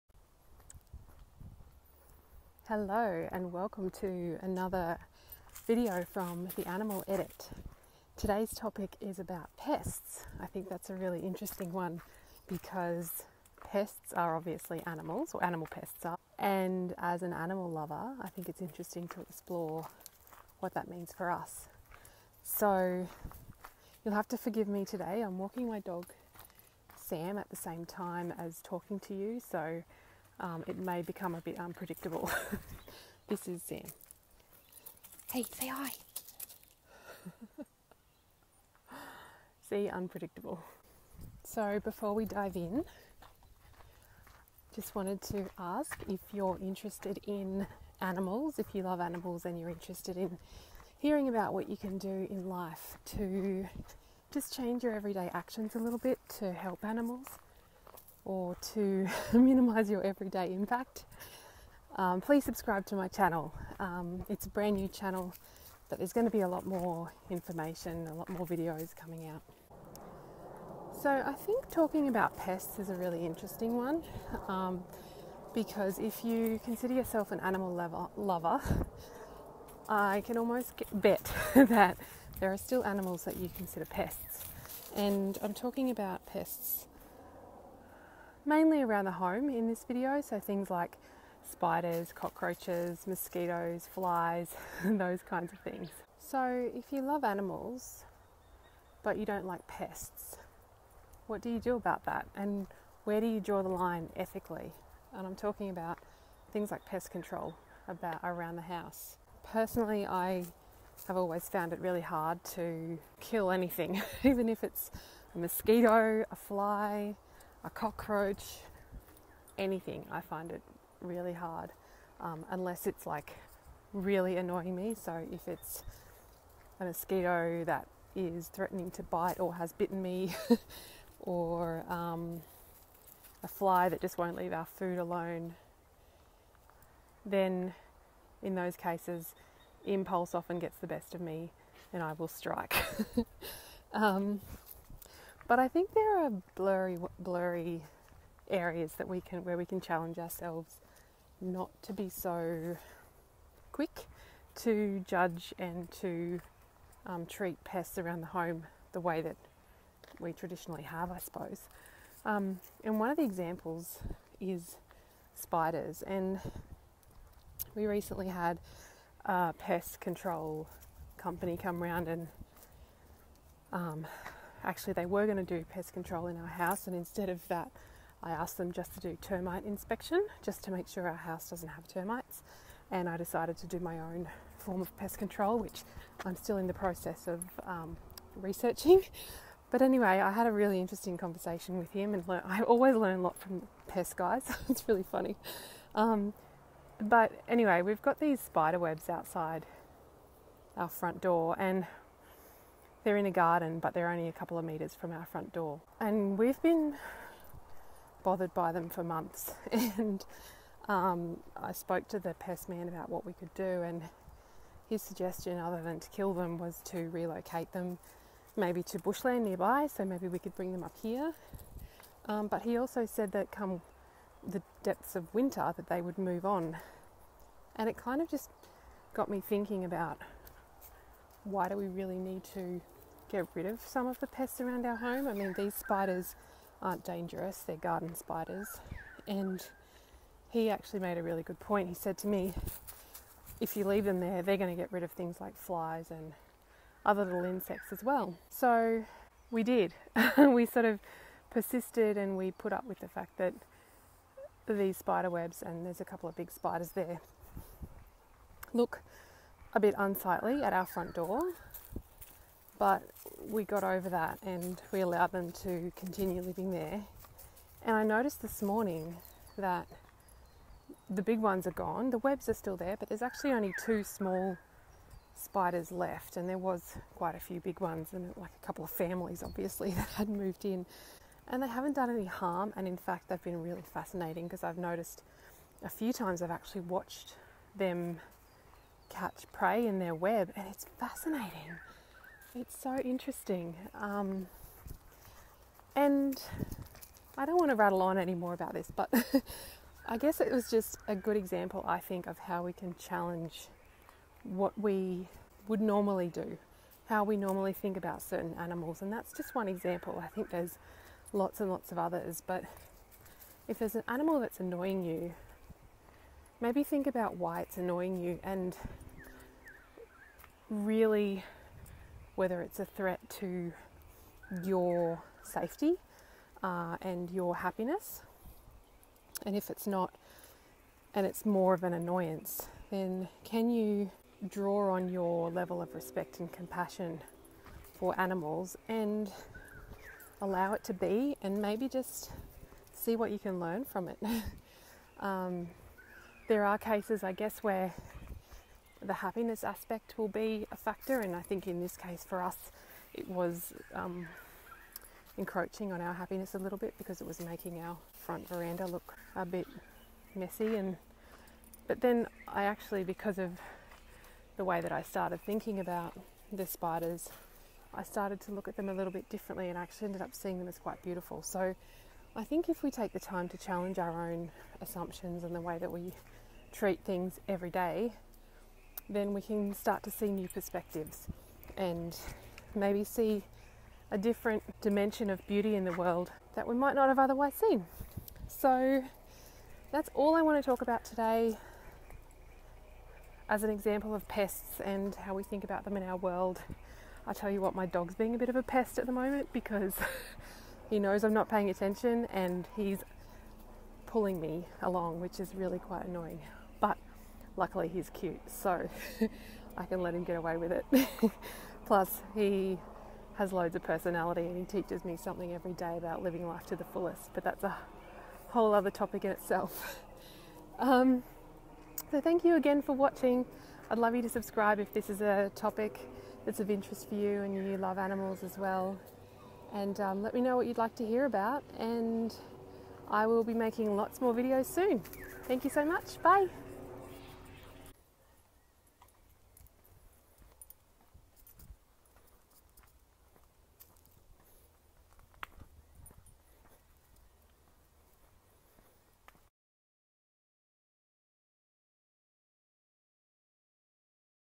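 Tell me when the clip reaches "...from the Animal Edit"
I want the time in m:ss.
0:06.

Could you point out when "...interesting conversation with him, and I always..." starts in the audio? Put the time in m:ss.
3:10.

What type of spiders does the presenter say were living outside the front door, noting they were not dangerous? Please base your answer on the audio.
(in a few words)
Garden spiders.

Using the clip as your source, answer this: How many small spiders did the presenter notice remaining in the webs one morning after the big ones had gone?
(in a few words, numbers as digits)
2.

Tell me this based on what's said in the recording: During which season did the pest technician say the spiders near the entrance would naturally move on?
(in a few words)
Winter.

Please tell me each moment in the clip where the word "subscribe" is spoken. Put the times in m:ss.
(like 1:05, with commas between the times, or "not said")
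1:02, 7:04.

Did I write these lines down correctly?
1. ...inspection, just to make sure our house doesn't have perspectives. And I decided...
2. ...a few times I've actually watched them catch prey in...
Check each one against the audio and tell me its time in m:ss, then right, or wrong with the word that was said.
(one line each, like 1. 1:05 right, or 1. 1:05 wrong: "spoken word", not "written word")
1. 2:59 wrong: "termites", not "perspectives"
2. 4:45 right.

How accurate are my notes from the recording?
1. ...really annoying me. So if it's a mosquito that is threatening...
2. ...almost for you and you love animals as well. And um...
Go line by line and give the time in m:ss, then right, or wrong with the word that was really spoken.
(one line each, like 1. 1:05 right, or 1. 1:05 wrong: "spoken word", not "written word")
1. 2:03 right
2. 7:06 wrong: "interest", not "almost".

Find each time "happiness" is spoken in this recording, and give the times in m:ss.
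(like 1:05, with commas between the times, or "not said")
5:27, 5:49, 5:56.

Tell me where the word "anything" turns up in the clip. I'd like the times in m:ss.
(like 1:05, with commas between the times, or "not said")
1:53, 1:59.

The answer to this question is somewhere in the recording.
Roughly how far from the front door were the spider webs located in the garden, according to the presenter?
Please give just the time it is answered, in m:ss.
3:24.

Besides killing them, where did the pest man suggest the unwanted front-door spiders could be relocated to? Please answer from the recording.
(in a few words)
Bushland nearby.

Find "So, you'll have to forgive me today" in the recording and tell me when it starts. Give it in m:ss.
0:22.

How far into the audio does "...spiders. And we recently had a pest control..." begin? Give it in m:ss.
2:45.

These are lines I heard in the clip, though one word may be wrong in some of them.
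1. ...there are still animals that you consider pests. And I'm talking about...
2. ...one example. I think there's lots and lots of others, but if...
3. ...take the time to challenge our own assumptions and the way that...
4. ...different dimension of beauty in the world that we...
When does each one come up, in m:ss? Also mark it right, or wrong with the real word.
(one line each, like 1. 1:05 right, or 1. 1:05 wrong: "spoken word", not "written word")
1. 1:22 right
2. 5:09 right
3. 6:12 right
4. 6:24 right.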